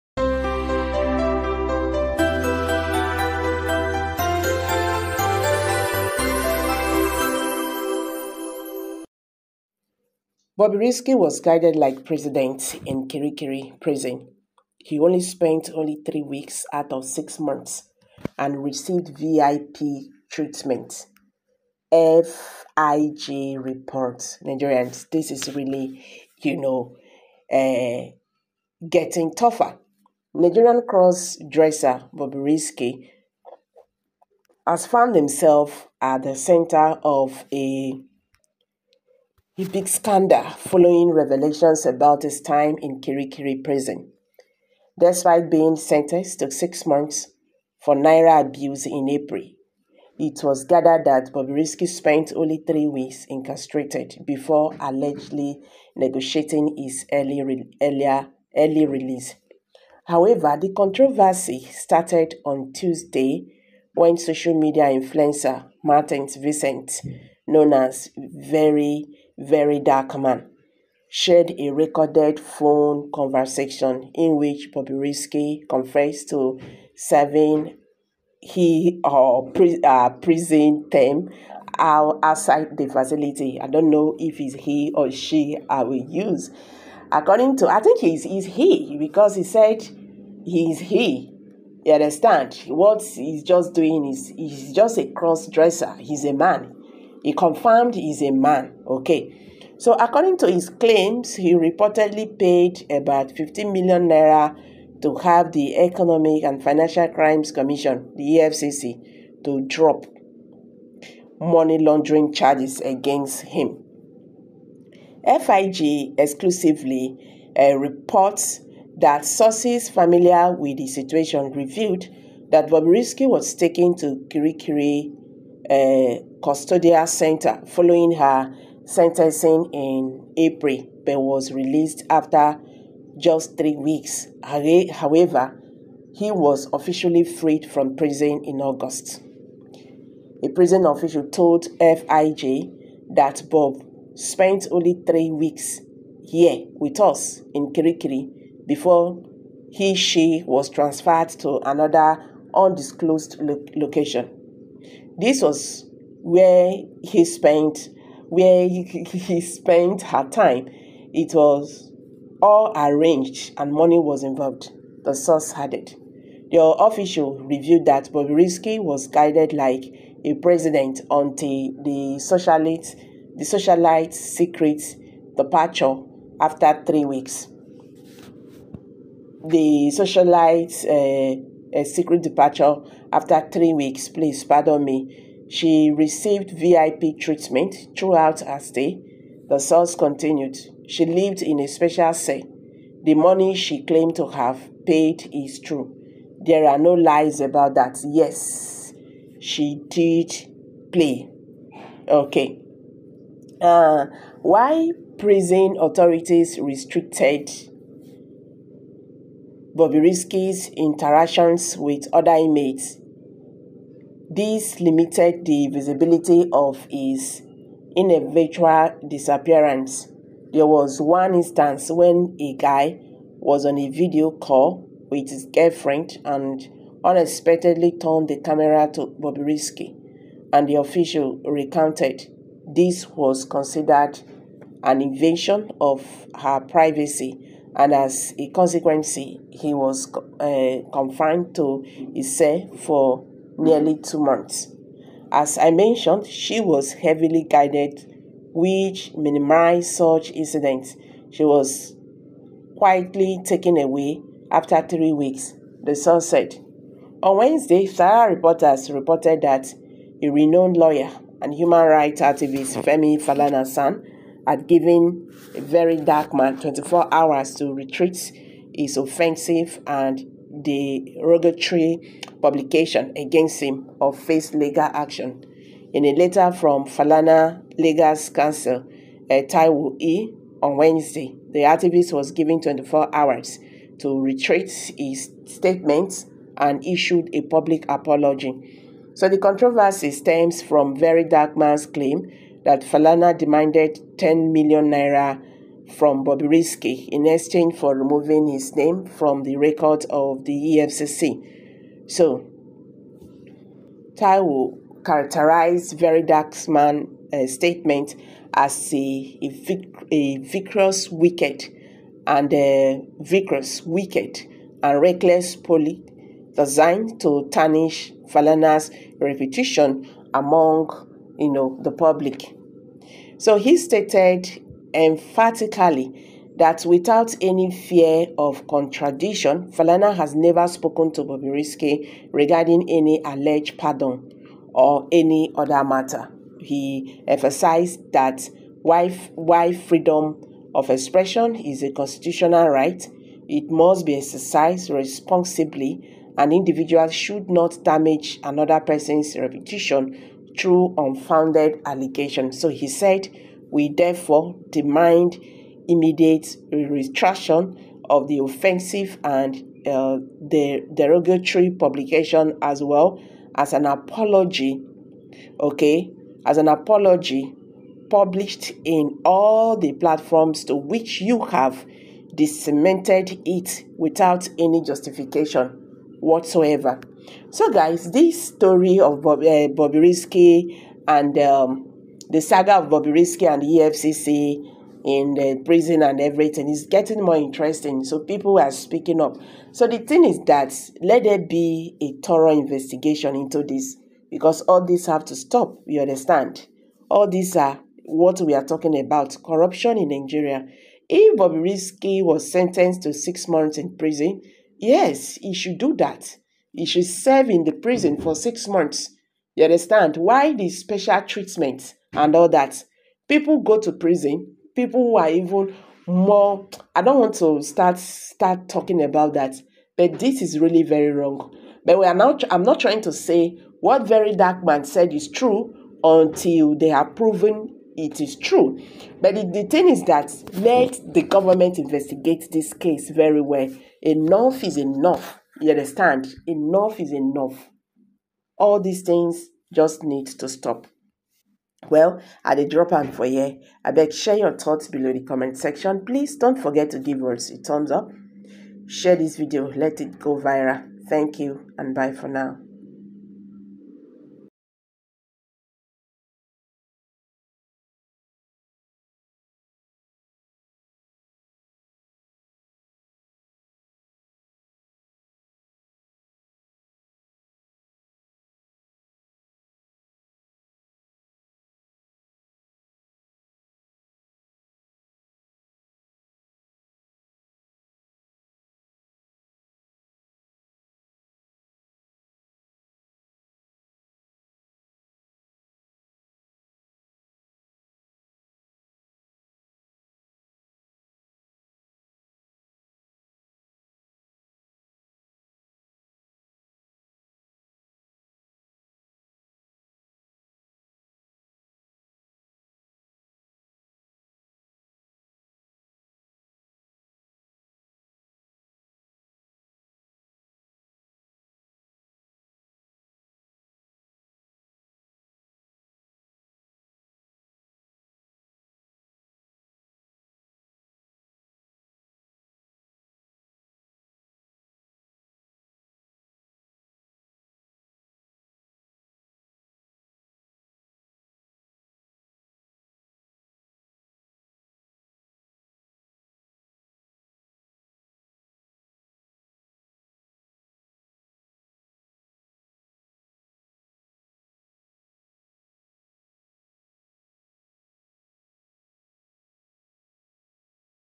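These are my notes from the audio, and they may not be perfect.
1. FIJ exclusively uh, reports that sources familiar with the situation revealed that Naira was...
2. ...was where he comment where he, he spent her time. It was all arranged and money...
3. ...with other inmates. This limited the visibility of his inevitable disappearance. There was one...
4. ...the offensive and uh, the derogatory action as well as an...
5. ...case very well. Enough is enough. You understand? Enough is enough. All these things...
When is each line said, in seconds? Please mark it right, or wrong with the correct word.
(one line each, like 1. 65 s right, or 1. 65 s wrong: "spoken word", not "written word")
1. 115 s wrong: "Bobrisky", not "Naira"
2. 155 s wrong: "spent", not "comment"
3. 211 s right
4. 358 s wrong: "publication", not "action"
5. 432 s right.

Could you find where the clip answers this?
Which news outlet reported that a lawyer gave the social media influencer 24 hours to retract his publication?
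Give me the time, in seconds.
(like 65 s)
257 s.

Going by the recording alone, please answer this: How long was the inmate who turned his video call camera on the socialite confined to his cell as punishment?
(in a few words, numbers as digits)
nearly two months.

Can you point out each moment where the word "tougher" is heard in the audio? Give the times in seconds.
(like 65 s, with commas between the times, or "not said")
29 s.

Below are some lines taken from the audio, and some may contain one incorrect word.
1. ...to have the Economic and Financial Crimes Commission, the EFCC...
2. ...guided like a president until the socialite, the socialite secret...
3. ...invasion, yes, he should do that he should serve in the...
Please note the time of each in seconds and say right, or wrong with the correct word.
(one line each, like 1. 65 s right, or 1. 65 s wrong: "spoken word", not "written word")
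1. 105 s right
2. 169 s right
3. 403 s wrong: "prison", not "invasion".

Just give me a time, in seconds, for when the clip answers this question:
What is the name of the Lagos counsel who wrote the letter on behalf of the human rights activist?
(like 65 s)
279 s.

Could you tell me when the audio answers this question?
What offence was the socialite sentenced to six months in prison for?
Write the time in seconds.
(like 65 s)
47 s.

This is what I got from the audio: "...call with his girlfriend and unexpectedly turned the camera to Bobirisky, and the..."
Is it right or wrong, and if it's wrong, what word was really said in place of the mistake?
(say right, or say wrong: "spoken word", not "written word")
right.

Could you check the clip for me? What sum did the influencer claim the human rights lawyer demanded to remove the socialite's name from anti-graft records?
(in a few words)
10 million naira.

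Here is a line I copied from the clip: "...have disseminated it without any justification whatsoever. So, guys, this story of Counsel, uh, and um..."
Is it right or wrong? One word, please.
wrong.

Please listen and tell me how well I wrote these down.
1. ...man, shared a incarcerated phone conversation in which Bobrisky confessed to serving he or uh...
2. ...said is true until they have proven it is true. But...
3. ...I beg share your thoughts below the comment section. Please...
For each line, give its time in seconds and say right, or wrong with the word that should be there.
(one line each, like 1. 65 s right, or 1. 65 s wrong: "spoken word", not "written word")
1. 70 s wrong: "recorded", not "incarcerated"
2. 424 s right
3. 443 s right.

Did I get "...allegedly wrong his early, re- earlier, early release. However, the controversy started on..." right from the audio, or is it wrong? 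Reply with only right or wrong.
wrong.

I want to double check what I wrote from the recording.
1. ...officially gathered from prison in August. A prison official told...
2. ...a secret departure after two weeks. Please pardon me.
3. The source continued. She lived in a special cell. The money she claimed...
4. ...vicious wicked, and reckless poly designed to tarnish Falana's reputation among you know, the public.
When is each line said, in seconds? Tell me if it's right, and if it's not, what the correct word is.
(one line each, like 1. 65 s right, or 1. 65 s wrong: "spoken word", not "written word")
1. 136 s wrong: "freed", not "gathered"
2. 181 s wrong: "three", not "two"
3. 189 s right
4. 313 s right.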